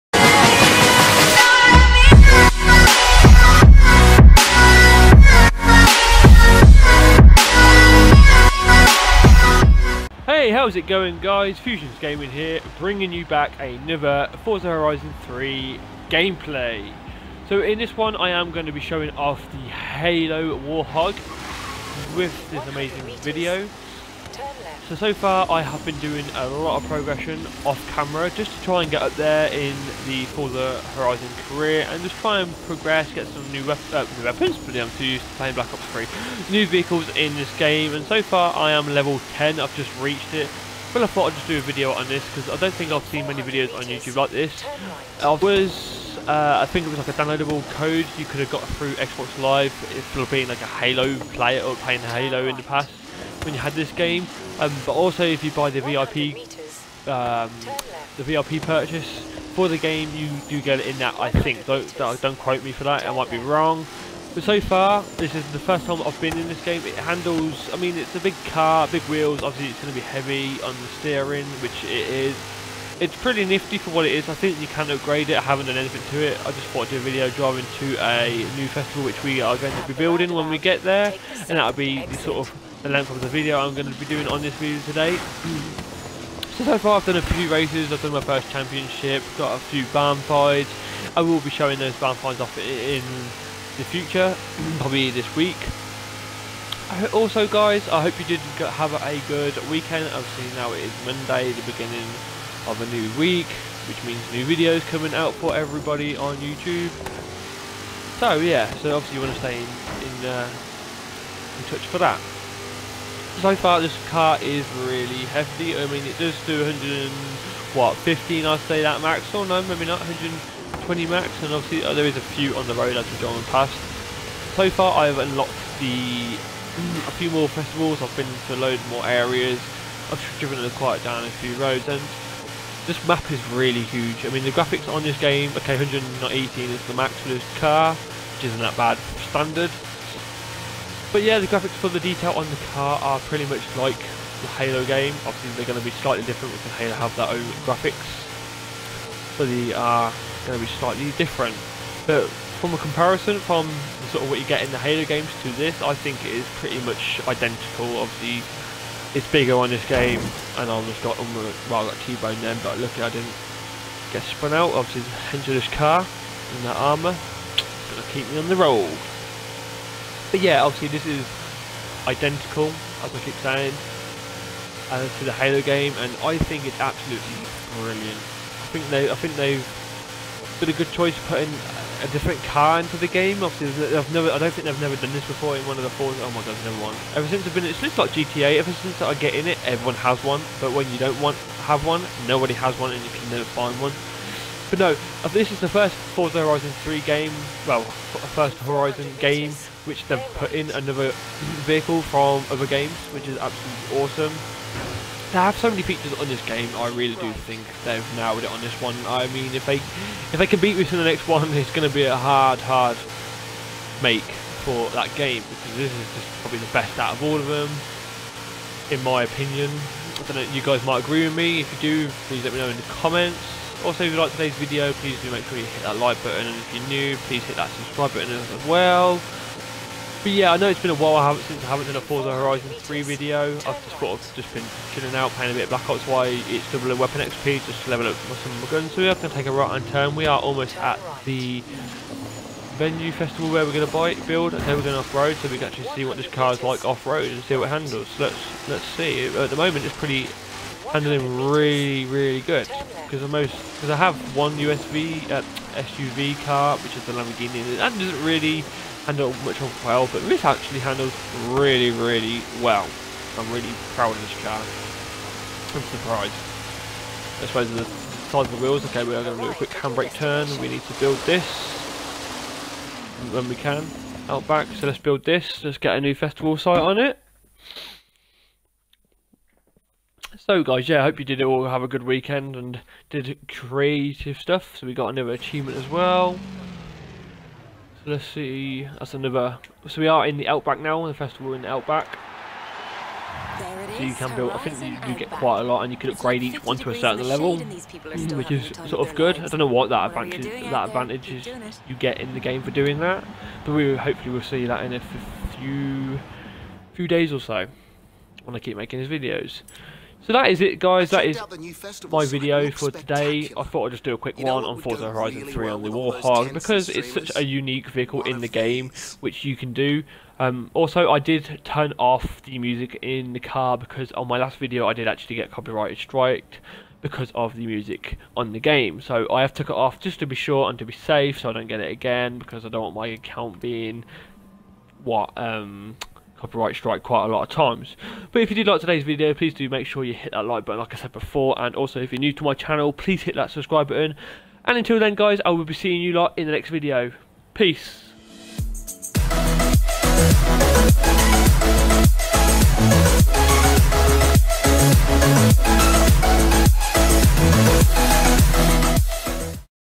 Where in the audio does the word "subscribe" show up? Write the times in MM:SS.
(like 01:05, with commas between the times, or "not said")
03:47, 05:43.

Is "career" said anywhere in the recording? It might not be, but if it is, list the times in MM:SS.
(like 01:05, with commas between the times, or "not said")
00:31.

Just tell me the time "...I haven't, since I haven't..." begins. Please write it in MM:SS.
03:51.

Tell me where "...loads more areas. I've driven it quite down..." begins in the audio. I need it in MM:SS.
02:08.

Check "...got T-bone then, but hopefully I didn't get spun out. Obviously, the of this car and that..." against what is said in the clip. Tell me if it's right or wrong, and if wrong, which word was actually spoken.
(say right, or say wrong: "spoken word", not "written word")
wrong: "luckily", not "hopefully".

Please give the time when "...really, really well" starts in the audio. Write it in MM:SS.
04:21.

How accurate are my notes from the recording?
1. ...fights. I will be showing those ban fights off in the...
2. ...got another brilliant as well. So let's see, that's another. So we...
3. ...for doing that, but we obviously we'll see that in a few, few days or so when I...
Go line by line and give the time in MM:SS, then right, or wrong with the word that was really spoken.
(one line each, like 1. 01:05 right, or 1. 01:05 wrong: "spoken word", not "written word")
1. 01:30 right
2. 04:44 wrong: "achievement", not "brilliant"
3. 05:02 wrong: "hopefully", not "obviously".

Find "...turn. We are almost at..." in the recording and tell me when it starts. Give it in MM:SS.
03:59.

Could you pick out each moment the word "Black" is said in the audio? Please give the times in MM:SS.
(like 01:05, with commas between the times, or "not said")
00:35, 03:55.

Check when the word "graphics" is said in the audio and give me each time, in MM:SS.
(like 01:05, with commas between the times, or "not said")
02:14, 02:21, 02:27.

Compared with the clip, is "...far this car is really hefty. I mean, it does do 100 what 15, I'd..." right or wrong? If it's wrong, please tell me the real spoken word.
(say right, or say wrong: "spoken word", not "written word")
right.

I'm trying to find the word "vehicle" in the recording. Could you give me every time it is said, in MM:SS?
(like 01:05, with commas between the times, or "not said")
00:36, 03:21, 05:17.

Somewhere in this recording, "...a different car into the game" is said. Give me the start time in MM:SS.
03:02.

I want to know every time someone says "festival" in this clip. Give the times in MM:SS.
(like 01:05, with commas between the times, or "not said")
01:18, 02:07, 04:03, 04:36, 04:51.